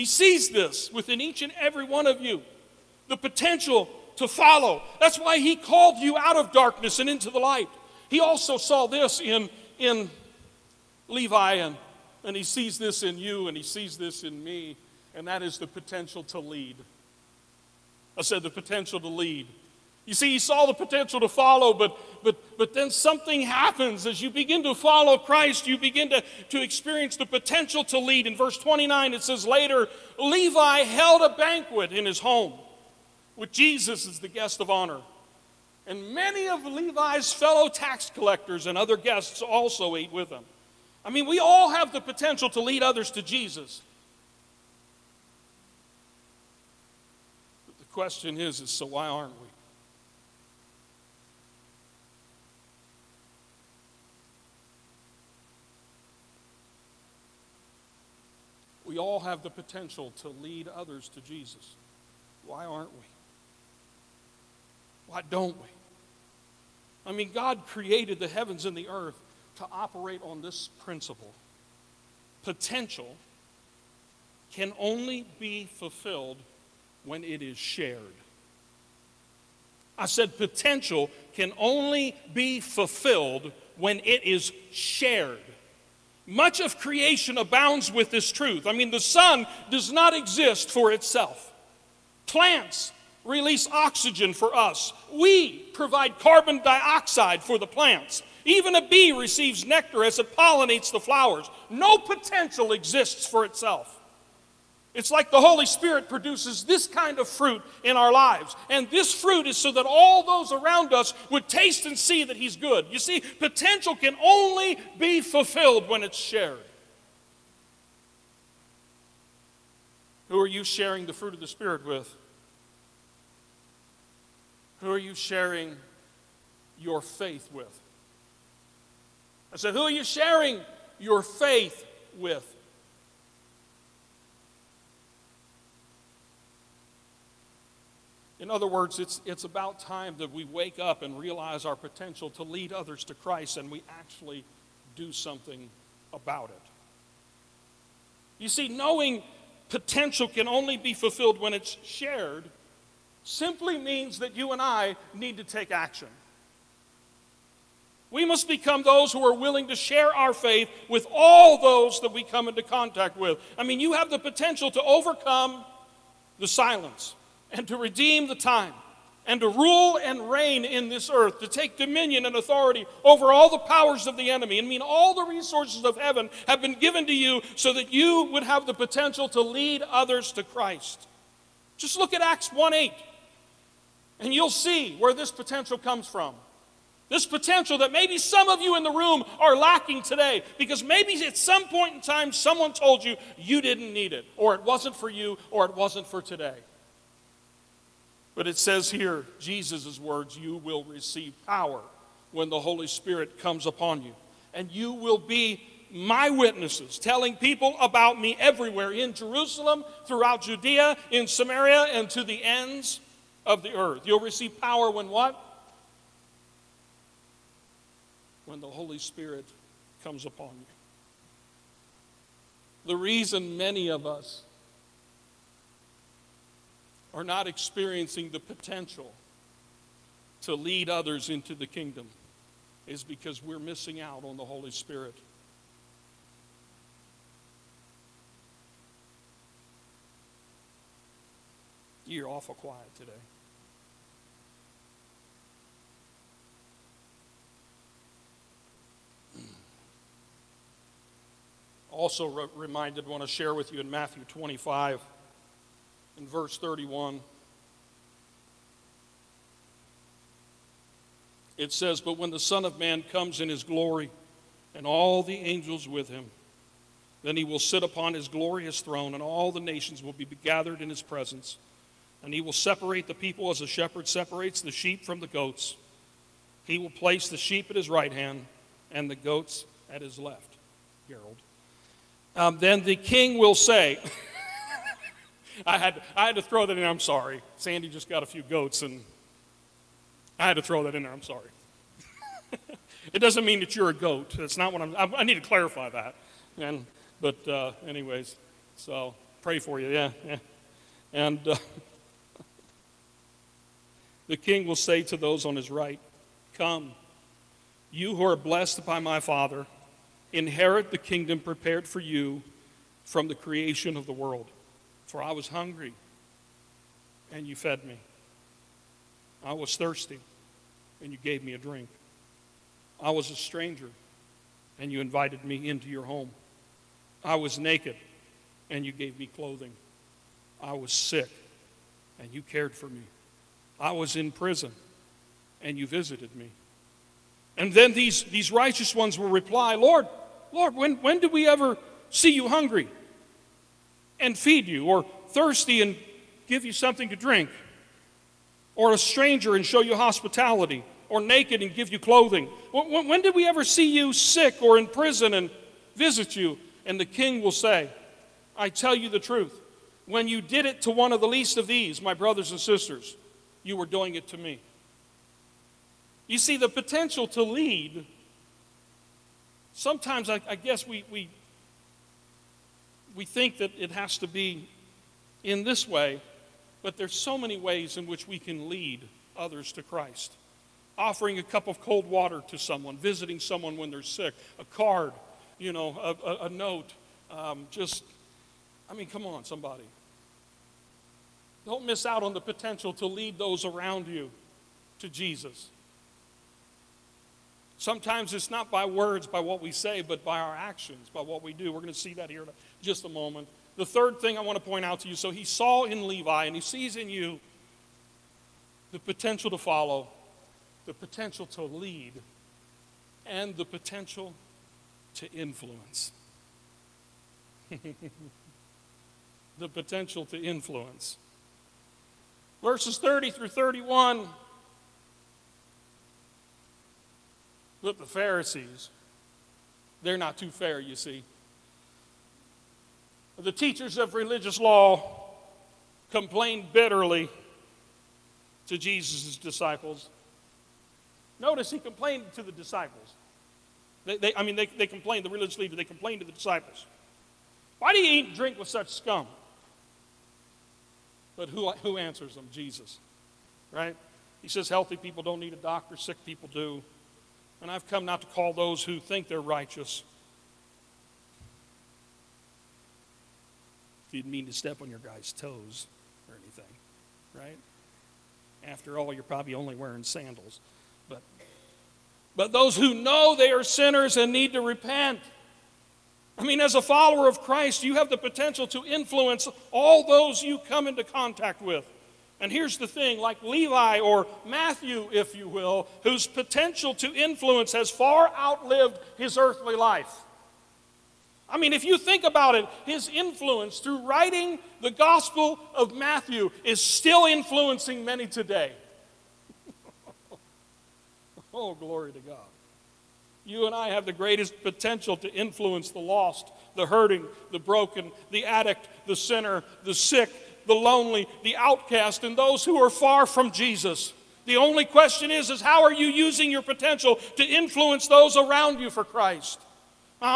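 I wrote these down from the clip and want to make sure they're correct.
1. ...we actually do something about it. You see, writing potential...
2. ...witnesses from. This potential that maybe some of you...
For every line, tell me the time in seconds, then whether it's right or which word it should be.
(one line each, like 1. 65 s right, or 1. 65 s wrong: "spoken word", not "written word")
1. 143 s wrong: "knowing", not "writing"
2. 185 s wrong: "comes", not "witnesses".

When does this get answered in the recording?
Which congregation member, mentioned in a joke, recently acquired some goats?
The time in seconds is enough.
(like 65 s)
287 s.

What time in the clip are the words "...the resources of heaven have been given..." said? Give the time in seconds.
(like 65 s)
175 s.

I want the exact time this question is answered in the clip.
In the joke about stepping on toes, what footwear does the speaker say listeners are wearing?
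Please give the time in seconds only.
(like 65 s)
470 s.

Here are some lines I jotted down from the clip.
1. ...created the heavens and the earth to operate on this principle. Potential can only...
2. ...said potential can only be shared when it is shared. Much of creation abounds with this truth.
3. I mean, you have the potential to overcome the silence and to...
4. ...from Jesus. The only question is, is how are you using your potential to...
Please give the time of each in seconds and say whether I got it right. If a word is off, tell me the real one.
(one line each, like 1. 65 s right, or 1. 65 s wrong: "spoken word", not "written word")
1. 67 s right
2. 80 s wrong: "fulfilled", not "shared"
3. 163 s right
4. 513 s right.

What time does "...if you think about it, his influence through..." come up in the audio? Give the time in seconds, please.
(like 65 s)
491 s.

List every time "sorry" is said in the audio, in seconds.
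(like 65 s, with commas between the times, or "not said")
286 s, 291 s.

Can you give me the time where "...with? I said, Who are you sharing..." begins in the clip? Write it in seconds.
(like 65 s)
127 s.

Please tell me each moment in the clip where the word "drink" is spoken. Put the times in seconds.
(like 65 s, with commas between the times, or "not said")
321 s, 347 s, 448 s.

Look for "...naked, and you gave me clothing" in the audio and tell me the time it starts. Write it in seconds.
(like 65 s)
327 s.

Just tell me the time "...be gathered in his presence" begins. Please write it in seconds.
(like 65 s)
270 s.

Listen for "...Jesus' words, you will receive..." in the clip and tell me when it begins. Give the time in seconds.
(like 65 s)
199 s.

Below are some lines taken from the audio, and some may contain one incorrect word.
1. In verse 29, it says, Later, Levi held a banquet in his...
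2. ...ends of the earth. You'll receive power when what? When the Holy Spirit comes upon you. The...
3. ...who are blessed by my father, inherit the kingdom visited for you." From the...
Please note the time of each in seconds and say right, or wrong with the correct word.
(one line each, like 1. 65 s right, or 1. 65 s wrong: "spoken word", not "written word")
1. 28 s right
2. 212 s right
3. 308 s wrong: "prepared", not "visited".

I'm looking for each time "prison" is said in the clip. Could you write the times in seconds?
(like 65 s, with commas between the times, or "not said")
334 s, 354 s.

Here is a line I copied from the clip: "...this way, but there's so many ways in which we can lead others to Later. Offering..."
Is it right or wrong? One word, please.
wrong.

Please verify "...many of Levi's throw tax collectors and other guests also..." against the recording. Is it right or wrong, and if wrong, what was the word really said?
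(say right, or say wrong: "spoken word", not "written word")
wrong: "fellow", not "throw".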